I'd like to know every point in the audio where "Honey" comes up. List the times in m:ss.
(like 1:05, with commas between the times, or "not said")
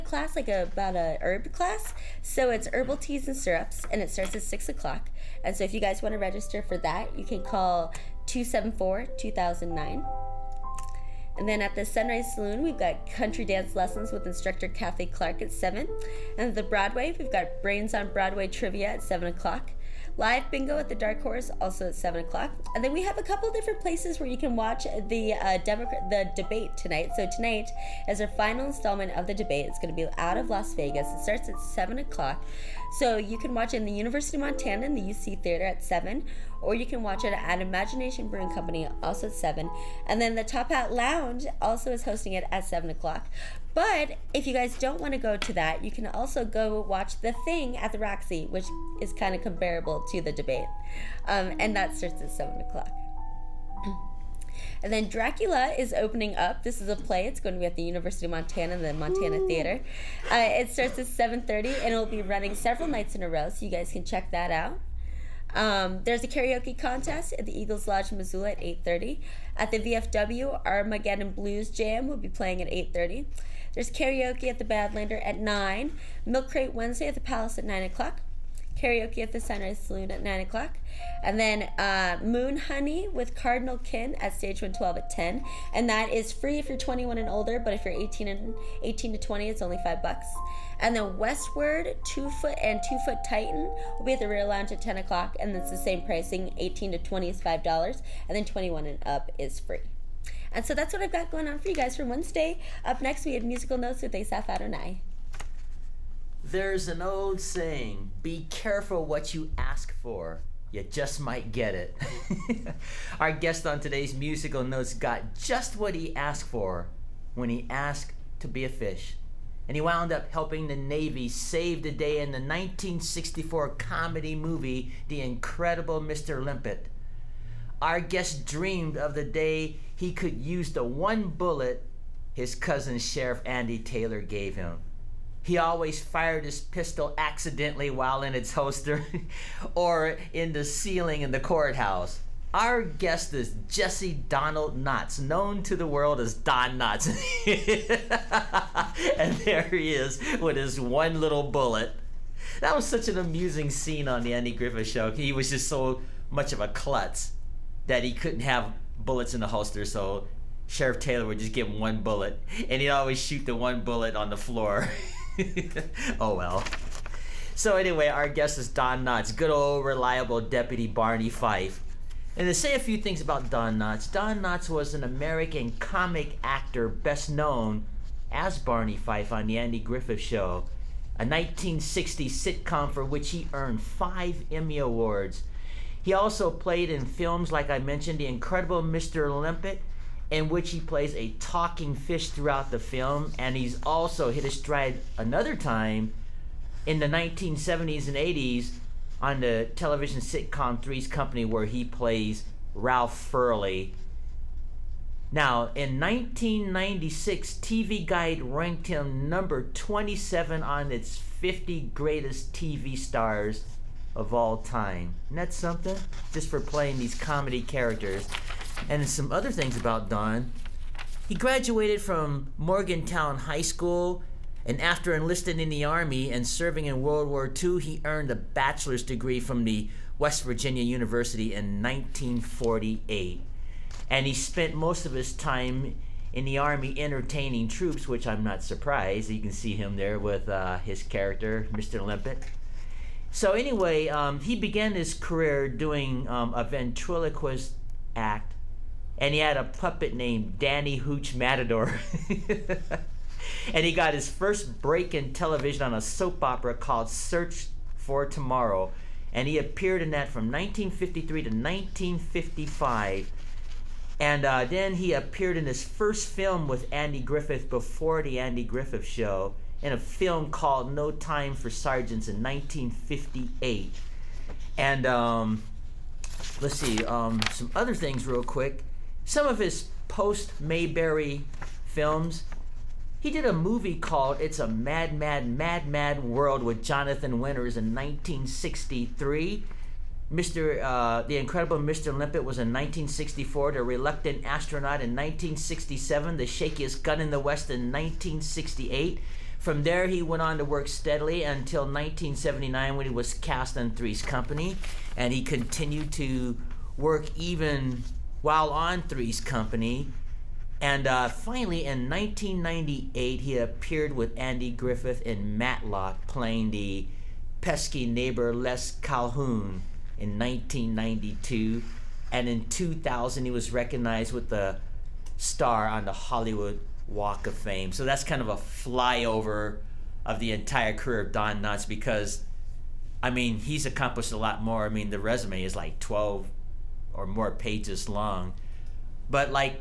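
1:22.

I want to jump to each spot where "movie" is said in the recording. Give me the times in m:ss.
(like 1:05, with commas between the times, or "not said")
2:04, 4:43.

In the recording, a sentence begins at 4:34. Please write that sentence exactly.
And um, let's see, um, some other things real quick.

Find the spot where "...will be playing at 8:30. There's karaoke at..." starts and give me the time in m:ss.
1:12.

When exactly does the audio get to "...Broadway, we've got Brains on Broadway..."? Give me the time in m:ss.
0:16.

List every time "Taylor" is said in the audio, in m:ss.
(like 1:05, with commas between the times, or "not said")
2:13, 2:40.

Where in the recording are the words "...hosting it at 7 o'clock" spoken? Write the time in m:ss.
0:42.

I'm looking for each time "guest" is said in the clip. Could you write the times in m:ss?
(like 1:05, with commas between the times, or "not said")
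1:53, 2:08, 2:22, 2:48.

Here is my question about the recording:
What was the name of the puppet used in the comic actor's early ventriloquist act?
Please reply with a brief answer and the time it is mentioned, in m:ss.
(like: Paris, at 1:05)
Danny Hooch Matador, at 4:10.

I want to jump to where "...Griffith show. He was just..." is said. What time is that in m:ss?
2:34.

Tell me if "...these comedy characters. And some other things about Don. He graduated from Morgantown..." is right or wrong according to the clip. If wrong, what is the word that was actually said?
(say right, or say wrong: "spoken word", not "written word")
right.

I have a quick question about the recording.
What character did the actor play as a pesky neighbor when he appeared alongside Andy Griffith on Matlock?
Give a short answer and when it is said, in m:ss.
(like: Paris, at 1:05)
Les Calhoun, at 5:18.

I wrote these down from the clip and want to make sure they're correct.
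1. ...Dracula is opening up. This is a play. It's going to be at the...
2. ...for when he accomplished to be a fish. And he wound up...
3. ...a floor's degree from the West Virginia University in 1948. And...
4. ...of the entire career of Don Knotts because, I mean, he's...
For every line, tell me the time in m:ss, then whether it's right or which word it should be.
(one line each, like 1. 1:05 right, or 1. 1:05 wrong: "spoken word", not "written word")
1. 0:55 right
2. 1:56 wrong: "asked", not "accomplished"
3. 3:48 wrong: "bachelor", not "floor"
4. 5:30 right.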